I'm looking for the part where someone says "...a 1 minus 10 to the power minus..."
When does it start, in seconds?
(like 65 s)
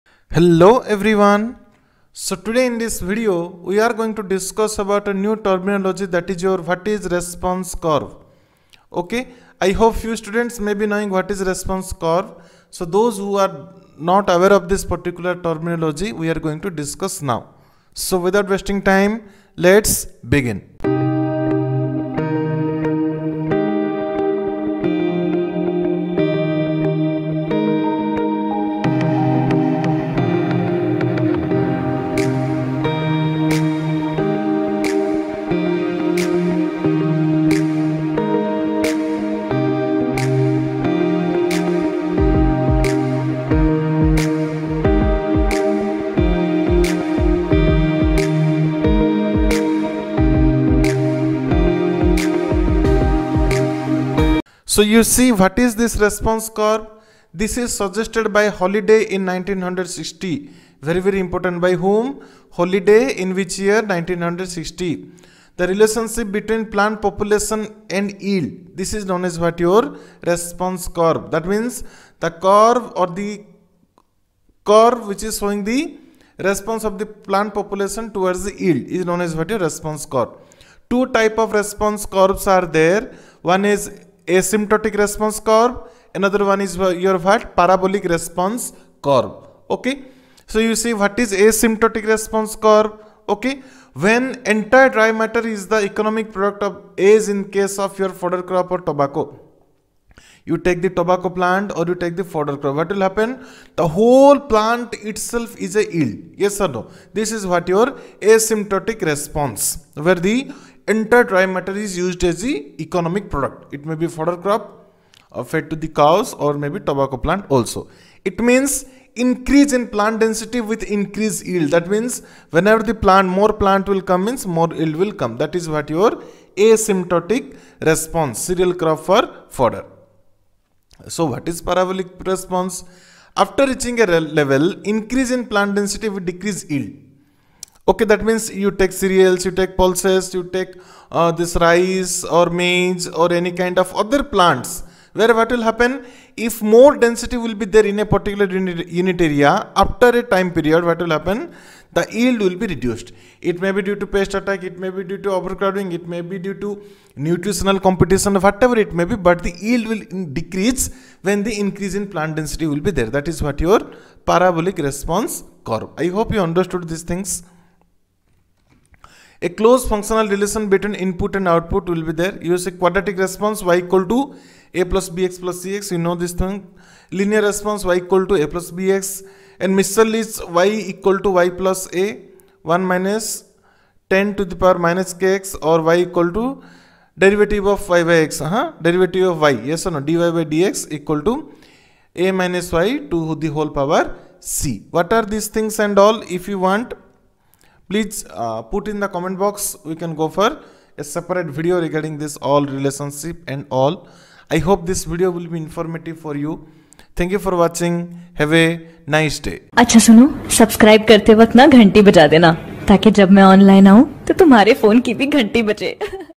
181 s.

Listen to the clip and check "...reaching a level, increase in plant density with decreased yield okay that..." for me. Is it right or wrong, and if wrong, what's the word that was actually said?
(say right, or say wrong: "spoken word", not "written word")
right.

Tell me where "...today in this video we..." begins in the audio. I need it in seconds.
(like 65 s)
2 s.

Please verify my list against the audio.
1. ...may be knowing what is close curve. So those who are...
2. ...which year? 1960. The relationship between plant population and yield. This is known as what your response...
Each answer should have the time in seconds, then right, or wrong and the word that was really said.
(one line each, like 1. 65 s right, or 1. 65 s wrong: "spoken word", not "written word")
1. 10 s wrong: "response", not "close"
2. 63 s right.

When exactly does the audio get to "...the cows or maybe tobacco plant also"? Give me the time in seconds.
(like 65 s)
115 s.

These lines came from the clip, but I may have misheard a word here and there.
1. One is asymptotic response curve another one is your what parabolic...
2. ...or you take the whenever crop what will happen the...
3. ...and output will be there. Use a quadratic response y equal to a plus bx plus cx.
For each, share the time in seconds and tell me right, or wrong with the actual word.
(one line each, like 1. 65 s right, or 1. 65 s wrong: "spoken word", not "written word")
1. 83 s right
2. 101 s wrong: "fodder", not "whenever"
3. 171 s right.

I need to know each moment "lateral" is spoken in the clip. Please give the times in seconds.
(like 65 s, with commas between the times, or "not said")
not said.